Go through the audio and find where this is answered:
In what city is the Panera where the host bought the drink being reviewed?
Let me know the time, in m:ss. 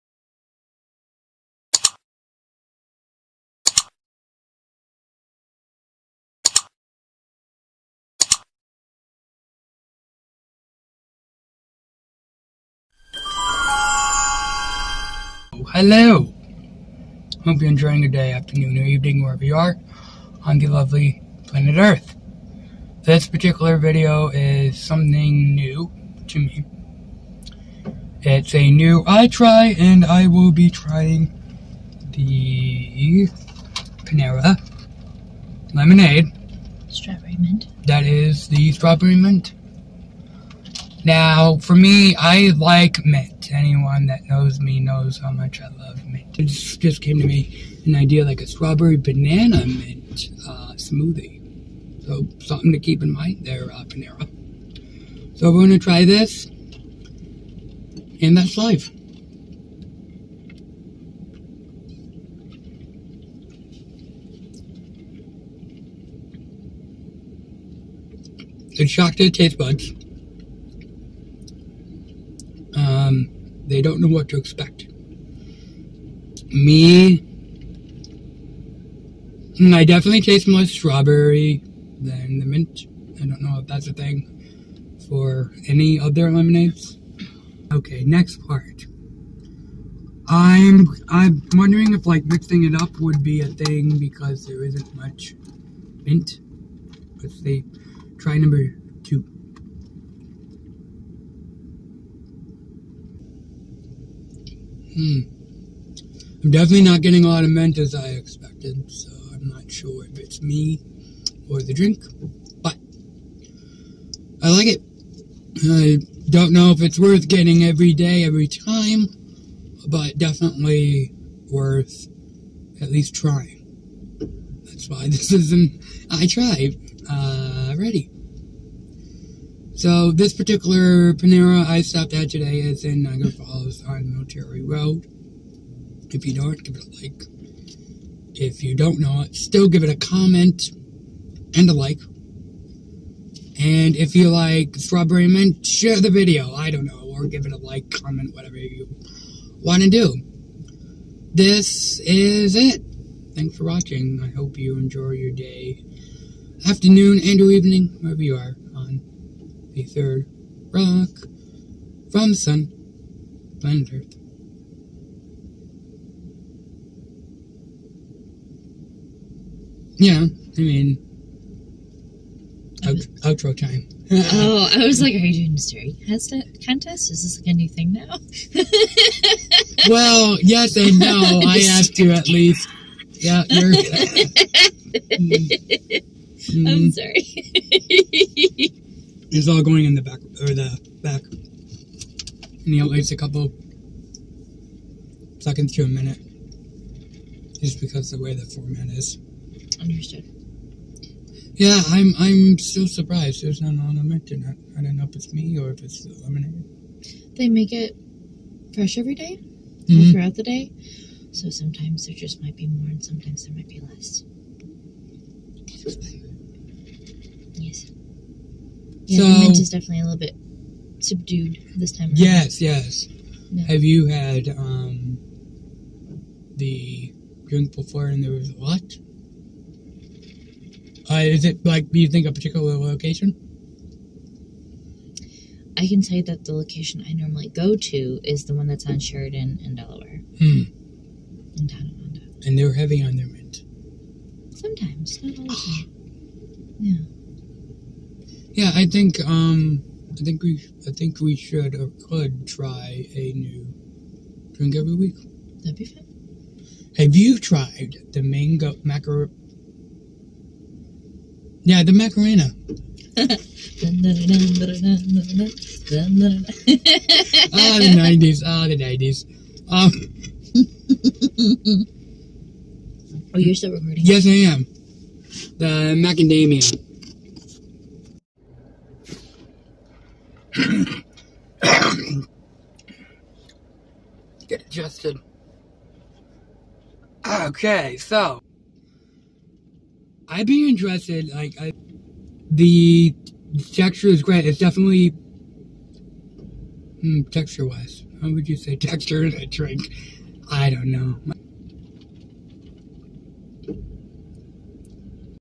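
2:13.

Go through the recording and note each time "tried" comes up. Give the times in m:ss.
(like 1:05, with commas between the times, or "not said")
2:06, 4:17.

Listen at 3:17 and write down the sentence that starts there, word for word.
Just because the way the format is.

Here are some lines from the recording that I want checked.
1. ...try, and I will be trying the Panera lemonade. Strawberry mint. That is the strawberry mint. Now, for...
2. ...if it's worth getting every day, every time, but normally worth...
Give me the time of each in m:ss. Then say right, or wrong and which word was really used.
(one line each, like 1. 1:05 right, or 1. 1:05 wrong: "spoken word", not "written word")
1. 0:29 right
2. 1:56 wrong: "definitely", not "normally".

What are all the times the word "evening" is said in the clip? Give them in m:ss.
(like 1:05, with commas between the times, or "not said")
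0:18, 2:37.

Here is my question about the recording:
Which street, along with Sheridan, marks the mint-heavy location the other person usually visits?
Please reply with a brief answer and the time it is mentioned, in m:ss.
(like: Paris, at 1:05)
Delaware, at 3:59.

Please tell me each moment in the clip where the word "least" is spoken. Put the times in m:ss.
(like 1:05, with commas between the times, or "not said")
2:02, 3:02.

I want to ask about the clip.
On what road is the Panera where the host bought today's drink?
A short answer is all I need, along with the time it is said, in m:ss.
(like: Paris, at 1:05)
Military Road, at 2:14.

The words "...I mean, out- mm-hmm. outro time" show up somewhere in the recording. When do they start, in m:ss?
2:50.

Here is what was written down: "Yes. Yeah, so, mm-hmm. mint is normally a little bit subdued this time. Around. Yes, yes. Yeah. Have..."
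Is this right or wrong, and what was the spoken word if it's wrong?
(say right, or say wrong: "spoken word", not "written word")
wrong: "definitely", not "normally".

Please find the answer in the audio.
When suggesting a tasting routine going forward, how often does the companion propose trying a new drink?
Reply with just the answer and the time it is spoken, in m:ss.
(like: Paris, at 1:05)
Every week, at 4:14.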